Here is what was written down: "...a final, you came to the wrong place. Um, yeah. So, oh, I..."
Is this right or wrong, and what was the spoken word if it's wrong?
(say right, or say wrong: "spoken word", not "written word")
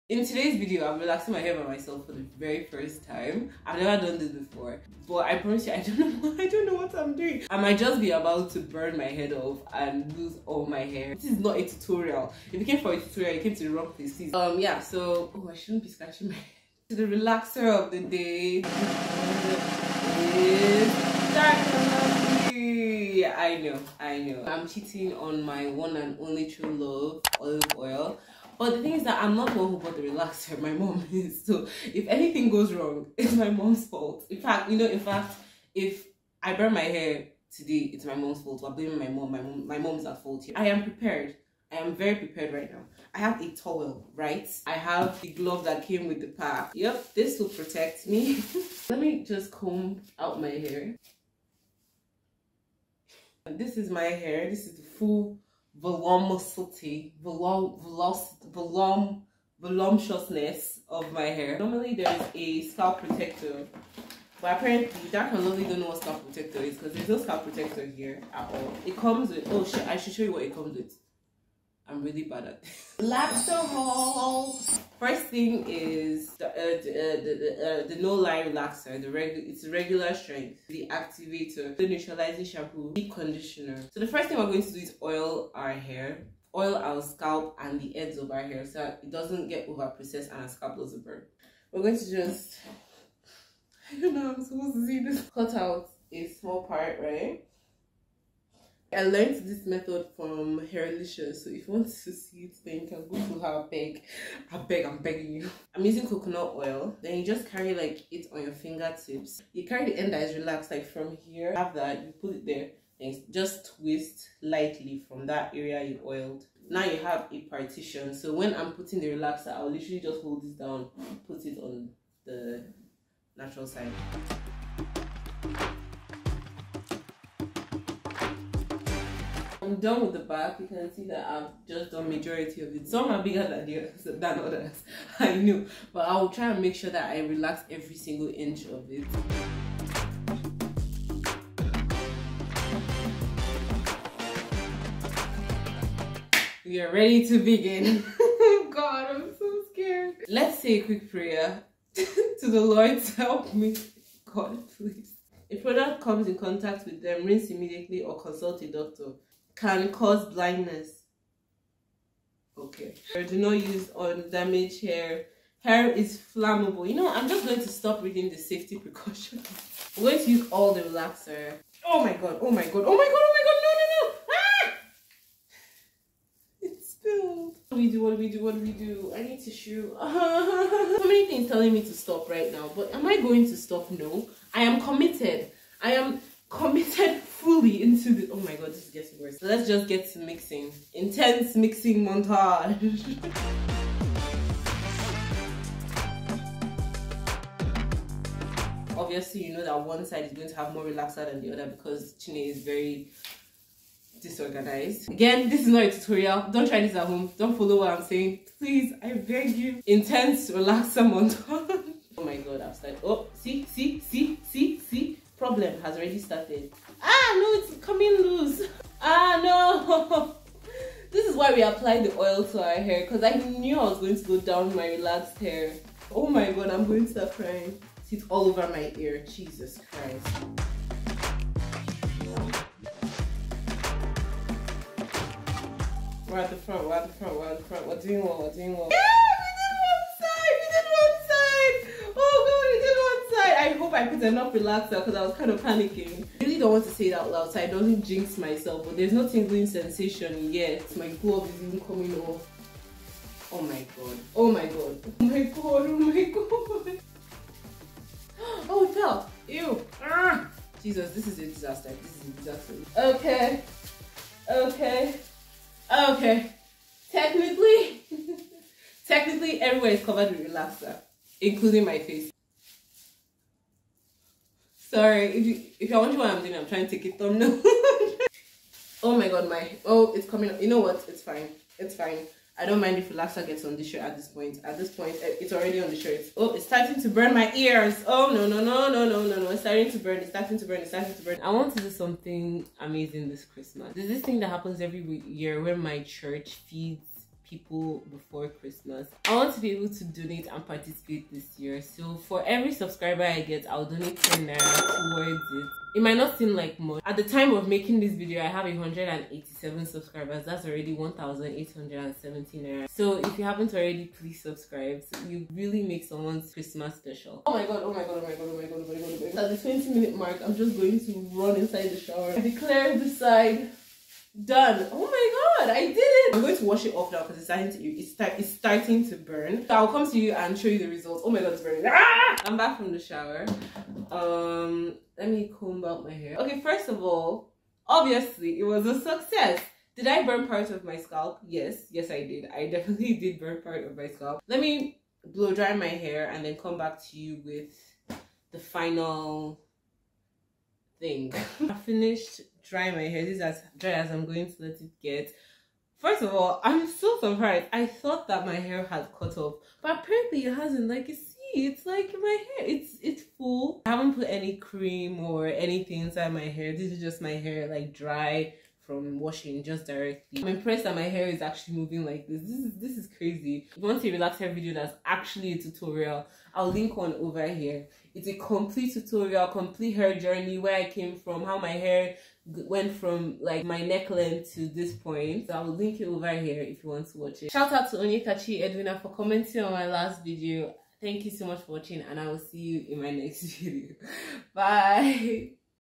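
wrong: "tutorial", not "final".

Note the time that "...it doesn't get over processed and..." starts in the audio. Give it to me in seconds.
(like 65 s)
88 s.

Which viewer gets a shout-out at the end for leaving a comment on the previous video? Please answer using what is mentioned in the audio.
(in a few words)
Onyekachi Edwina.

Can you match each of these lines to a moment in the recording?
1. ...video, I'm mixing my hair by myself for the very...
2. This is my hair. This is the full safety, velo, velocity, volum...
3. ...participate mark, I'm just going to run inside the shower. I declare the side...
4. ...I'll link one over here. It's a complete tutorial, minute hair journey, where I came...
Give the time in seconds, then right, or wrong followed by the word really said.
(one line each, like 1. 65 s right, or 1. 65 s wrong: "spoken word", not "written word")
1. 0 s wrong: "relaxing", not "mixing"
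2. 53 s wrong: "velocity", not "safety"
3. 319 s wrong: "minute", not "participate"
4. 376 s wrong: "complete", not "minute".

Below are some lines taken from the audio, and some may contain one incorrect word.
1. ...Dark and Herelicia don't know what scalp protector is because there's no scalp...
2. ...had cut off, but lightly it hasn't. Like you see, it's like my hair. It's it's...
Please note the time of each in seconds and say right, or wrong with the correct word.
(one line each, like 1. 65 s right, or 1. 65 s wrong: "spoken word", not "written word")
1. 65 s wrong: "Lovely", not "Herelicia"
2. 358 s wrong: "apparently", not "lightly".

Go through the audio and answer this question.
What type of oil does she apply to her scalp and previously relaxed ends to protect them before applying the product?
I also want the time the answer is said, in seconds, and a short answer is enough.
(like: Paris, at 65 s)
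Coconut oil, at 106 s.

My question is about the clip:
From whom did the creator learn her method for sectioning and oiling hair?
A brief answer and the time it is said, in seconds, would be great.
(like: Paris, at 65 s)
Herelicia, at 100 s.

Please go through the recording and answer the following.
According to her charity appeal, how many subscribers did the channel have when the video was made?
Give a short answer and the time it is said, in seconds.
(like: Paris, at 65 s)
187, at 308 s.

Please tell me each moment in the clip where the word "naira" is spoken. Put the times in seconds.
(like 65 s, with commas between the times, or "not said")
304 s, 312 s.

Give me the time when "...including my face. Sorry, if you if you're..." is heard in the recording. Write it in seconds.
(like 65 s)
271 s.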